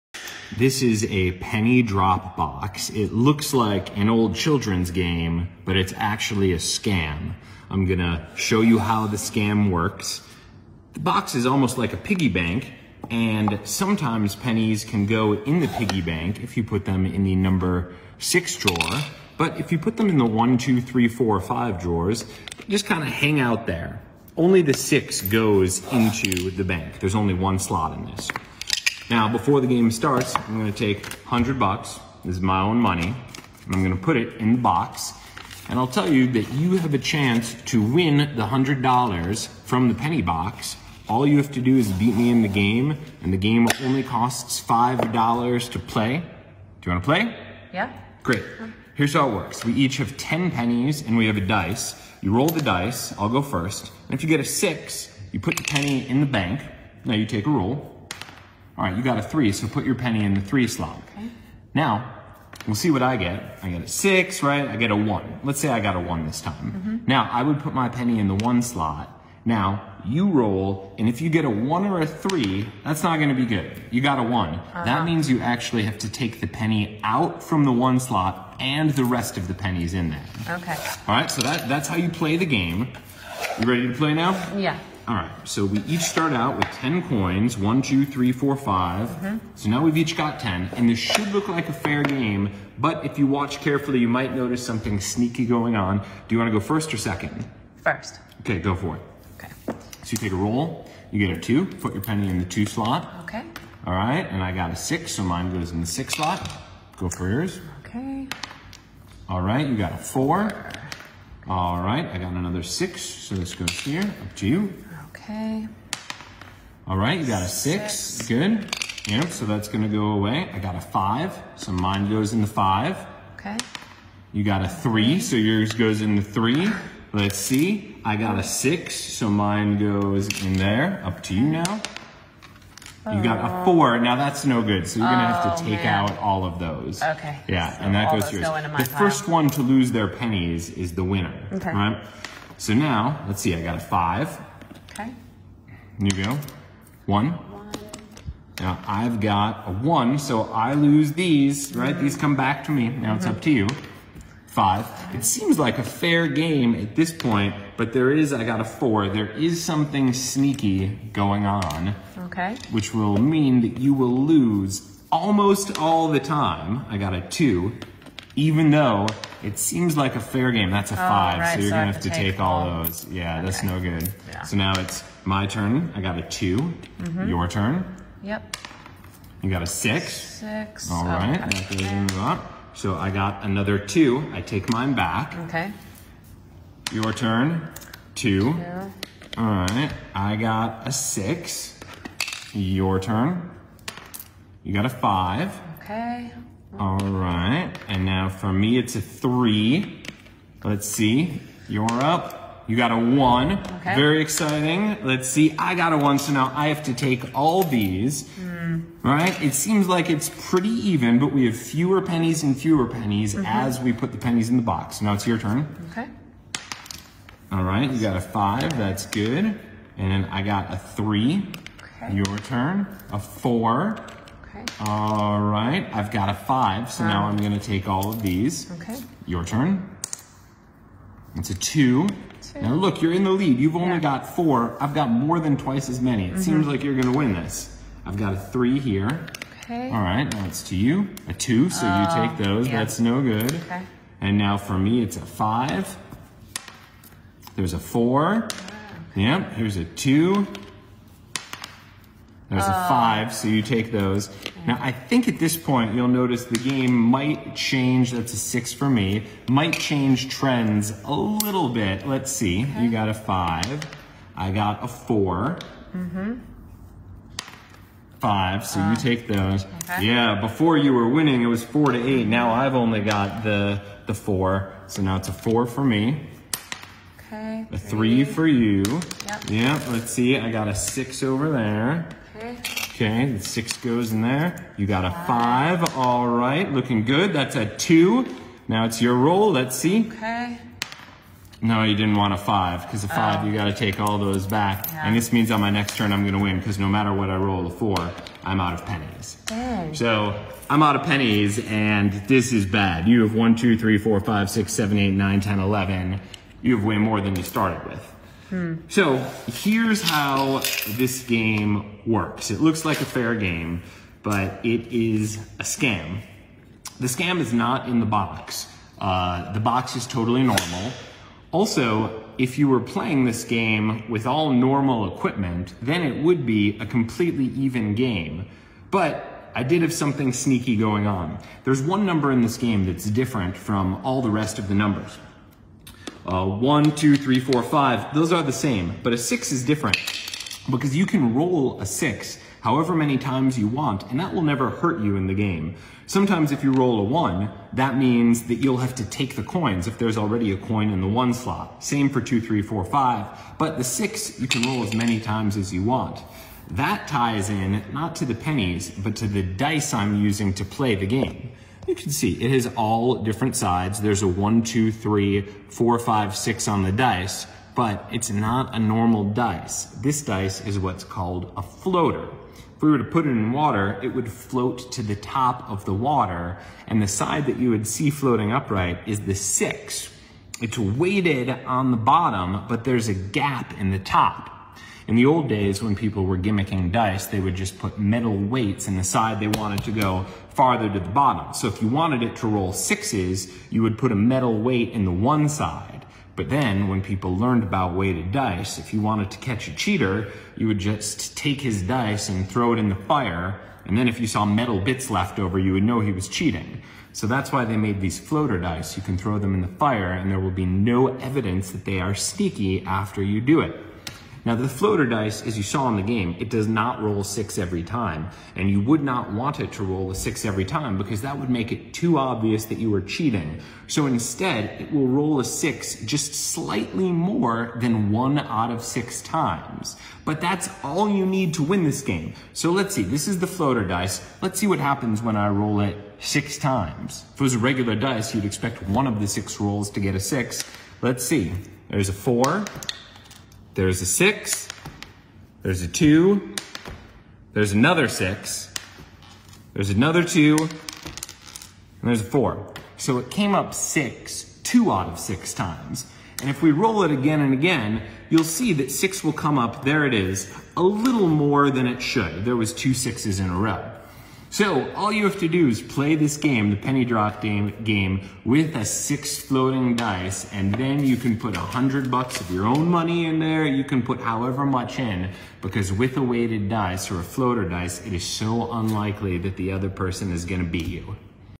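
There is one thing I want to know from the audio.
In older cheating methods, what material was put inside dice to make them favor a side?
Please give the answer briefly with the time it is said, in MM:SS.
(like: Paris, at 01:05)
metal weights, at 06:27.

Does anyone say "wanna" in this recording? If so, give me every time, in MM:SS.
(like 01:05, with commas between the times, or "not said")
00:46, 01:36.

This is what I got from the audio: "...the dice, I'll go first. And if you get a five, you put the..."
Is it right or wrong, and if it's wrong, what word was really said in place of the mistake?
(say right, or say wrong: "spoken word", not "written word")
wrong: "six", not "five".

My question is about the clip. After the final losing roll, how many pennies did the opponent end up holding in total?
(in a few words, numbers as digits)
11.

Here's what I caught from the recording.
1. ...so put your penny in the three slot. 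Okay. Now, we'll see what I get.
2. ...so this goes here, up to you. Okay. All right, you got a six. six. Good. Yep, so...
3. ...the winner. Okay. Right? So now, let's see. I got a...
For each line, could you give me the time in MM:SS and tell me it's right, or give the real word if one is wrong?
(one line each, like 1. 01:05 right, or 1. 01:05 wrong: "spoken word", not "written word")
1. 00:59 right
2. 01:53 right
3. 02:20 right.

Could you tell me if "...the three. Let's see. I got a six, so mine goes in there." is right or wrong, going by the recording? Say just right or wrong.
right.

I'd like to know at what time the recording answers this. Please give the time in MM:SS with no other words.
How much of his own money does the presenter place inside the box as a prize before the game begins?
00:31.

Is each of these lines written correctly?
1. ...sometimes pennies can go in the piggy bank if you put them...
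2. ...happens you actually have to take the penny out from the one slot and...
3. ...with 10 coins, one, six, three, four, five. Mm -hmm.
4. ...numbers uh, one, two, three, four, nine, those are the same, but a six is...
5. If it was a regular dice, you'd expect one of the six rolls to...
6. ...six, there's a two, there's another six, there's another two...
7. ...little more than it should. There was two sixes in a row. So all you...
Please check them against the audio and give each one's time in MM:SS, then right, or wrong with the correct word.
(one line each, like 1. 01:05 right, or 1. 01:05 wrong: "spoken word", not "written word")
1. 00:13 right
2. 01:15 wrong: "means", not "happens"
3. 01:26 wrong: "two", not "six"
4. 05:34 wrong: "five", not "nine"
5. 07:17 right
6. 07:24 right
7. 07:40 right.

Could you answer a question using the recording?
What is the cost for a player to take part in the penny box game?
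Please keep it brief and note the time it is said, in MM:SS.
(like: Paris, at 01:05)
$5, at 00:44.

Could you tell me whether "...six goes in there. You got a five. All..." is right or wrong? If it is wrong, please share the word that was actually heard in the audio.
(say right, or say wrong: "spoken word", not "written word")
right.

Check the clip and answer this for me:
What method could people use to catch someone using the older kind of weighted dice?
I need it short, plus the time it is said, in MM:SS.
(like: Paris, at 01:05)
throw it in the fire, at 06:42.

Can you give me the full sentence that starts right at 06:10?
This dice is what's called a floater.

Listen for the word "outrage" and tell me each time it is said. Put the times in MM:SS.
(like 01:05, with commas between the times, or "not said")
not said.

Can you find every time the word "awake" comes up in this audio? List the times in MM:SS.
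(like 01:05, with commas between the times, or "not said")
not said.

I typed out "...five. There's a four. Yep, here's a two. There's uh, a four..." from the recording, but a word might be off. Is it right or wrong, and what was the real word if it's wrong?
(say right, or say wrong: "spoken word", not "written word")
wrong: "five", not "four".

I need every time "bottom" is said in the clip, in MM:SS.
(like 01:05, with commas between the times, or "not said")
06:21, 06:31.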